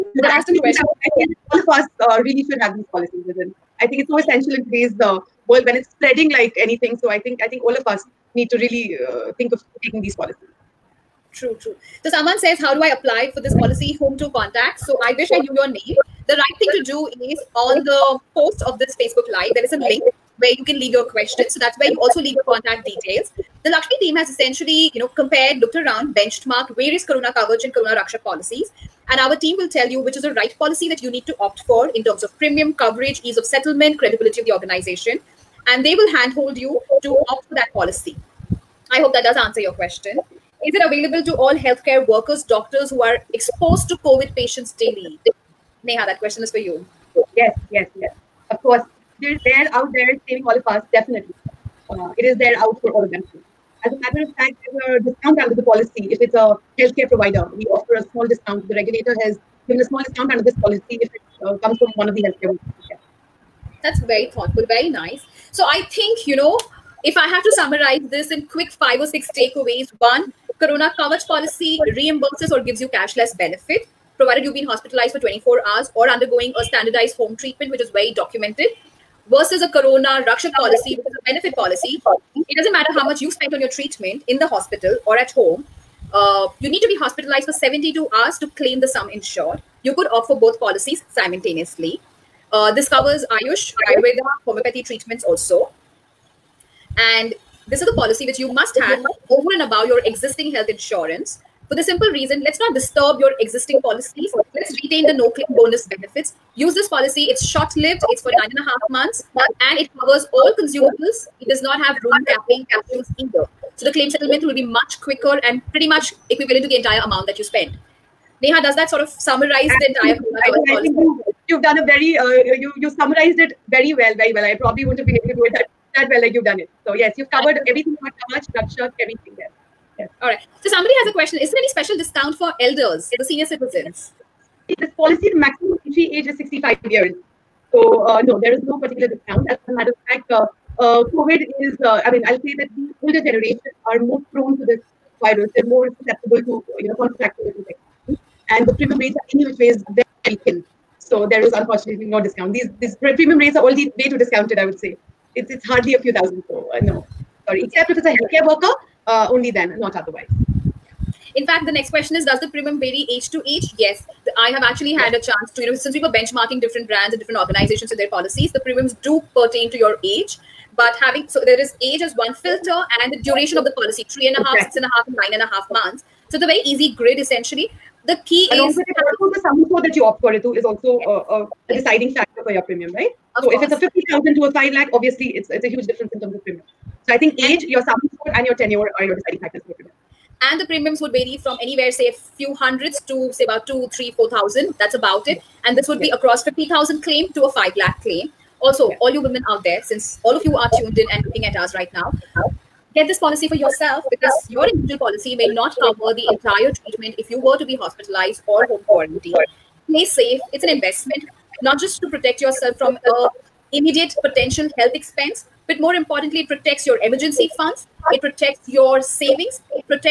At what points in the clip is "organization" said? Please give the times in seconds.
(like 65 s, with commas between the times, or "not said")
34 s, 167 s.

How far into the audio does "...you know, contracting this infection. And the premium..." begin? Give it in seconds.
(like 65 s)
146 s.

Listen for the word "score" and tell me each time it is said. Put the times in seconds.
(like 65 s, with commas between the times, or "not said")
179 s, 188 s.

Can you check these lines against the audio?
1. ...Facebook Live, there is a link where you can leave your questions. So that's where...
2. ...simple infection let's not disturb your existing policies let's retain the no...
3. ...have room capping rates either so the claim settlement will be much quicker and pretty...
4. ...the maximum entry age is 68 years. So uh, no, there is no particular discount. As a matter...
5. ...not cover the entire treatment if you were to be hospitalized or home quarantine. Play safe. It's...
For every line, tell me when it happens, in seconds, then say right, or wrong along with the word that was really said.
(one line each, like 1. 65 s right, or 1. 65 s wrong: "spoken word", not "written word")
1. 18 s right
2. 101 s wrong: "reason", not "infection"
3. 111 s wrong: "capsules", not "rates"
4. 135 s wrong: "65", not "68"
5. 205 s right.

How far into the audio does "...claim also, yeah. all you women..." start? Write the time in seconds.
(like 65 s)
198 s.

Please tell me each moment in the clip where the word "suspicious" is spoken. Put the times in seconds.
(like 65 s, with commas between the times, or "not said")
not said.